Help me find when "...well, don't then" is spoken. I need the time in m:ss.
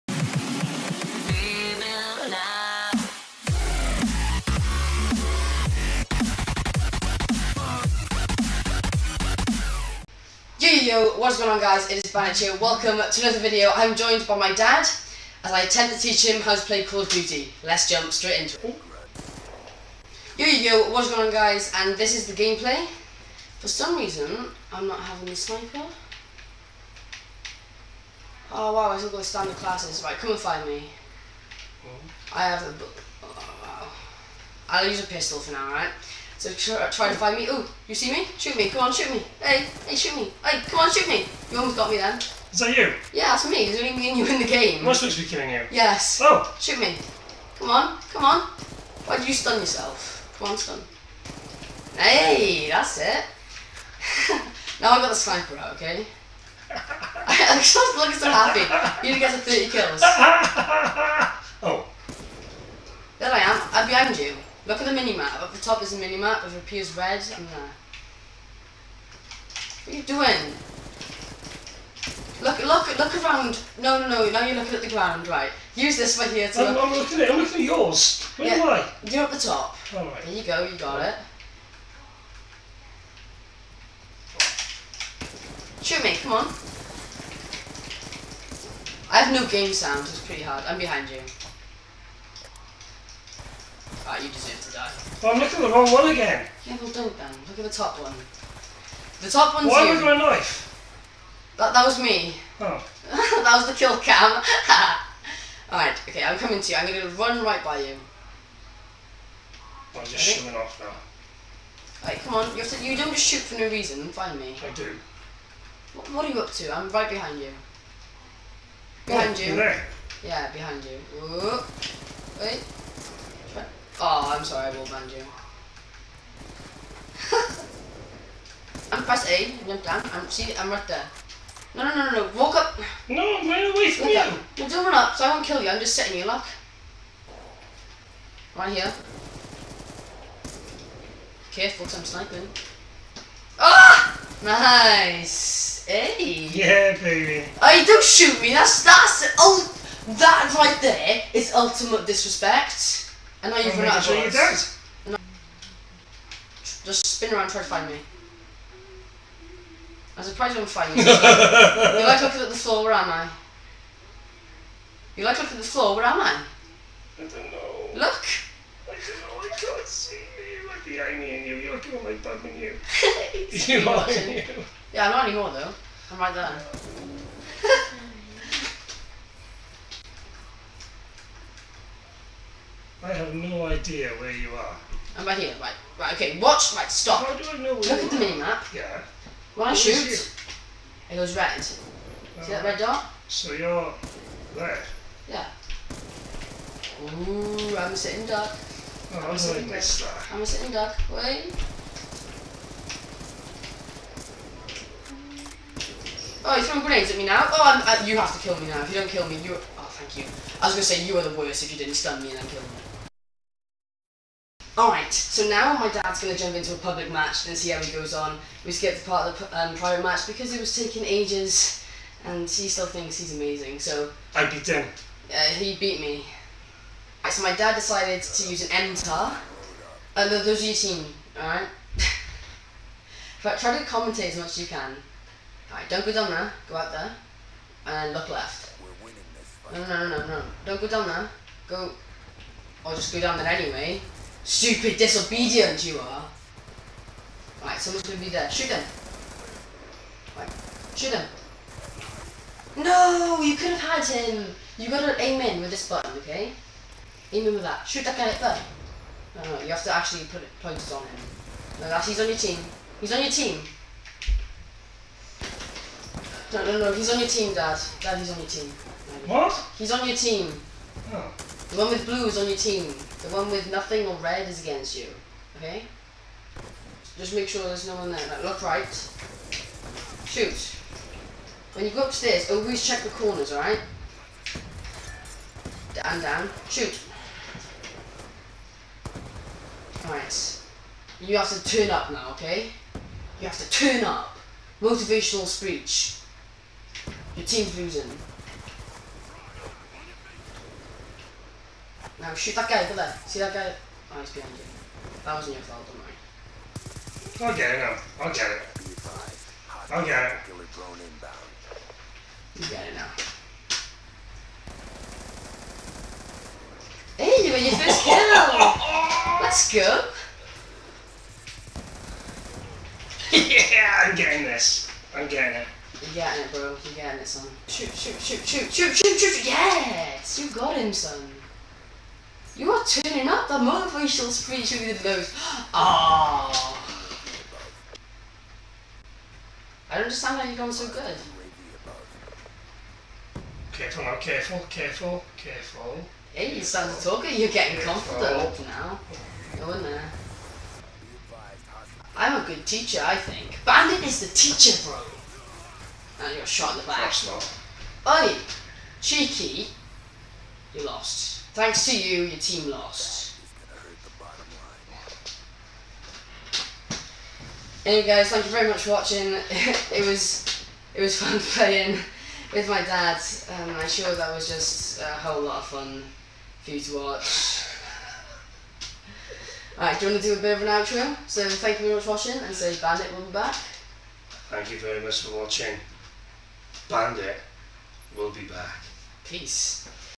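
1:36.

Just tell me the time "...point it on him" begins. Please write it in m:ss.
4:20.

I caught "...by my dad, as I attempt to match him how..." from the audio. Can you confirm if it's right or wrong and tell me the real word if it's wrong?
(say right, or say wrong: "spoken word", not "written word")
wrong: "teach", not "match".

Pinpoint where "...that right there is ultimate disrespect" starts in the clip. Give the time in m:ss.
2:30.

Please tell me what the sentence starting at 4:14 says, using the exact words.
You gotta aim in with this button, okay?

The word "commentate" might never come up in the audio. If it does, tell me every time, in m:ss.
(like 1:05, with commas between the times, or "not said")
3:53.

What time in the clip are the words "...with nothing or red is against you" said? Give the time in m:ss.
4:33.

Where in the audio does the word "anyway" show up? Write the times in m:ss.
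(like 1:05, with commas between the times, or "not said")
4:03, 6:07.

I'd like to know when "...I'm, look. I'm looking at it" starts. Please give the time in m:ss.
1:16.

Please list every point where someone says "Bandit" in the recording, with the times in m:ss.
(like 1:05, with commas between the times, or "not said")
0:12, 5:53, 6:22, 6:26.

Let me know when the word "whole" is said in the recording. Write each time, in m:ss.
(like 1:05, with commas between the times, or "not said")
6:15.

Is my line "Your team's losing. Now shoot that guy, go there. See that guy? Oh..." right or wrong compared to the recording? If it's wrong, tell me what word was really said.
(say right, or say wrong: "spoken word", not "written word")
right.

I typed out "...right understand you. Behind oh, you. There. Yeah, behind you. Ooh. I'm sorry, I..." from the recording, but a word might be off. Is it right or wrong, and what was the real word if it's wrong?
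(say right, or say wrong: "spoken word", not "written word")
wrong: "behind", not "understand".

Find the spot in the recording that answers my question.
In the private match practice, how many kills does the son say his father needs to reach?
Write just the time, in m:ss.
0:59.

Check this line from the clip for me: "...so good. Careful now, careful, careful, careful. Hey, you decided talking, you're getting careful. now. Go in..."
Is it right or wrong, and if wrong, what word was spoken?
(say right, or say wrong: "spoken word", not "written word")
wrong: "started", not "decided".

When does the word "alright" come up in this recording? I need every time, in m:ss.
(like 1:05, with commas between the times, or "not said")
1:45, 1:52, 3:34, 3:51, 3:55, 4:43, 4:50, 6:19.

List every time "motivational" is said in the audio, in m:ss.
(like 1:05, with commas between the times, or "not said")
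4:54, 5:33.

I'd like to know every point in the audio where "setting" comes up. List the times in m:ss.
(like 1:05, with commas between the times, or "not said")
2:15.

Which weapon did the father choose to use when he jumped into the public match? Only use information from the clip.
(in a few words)
MTAR.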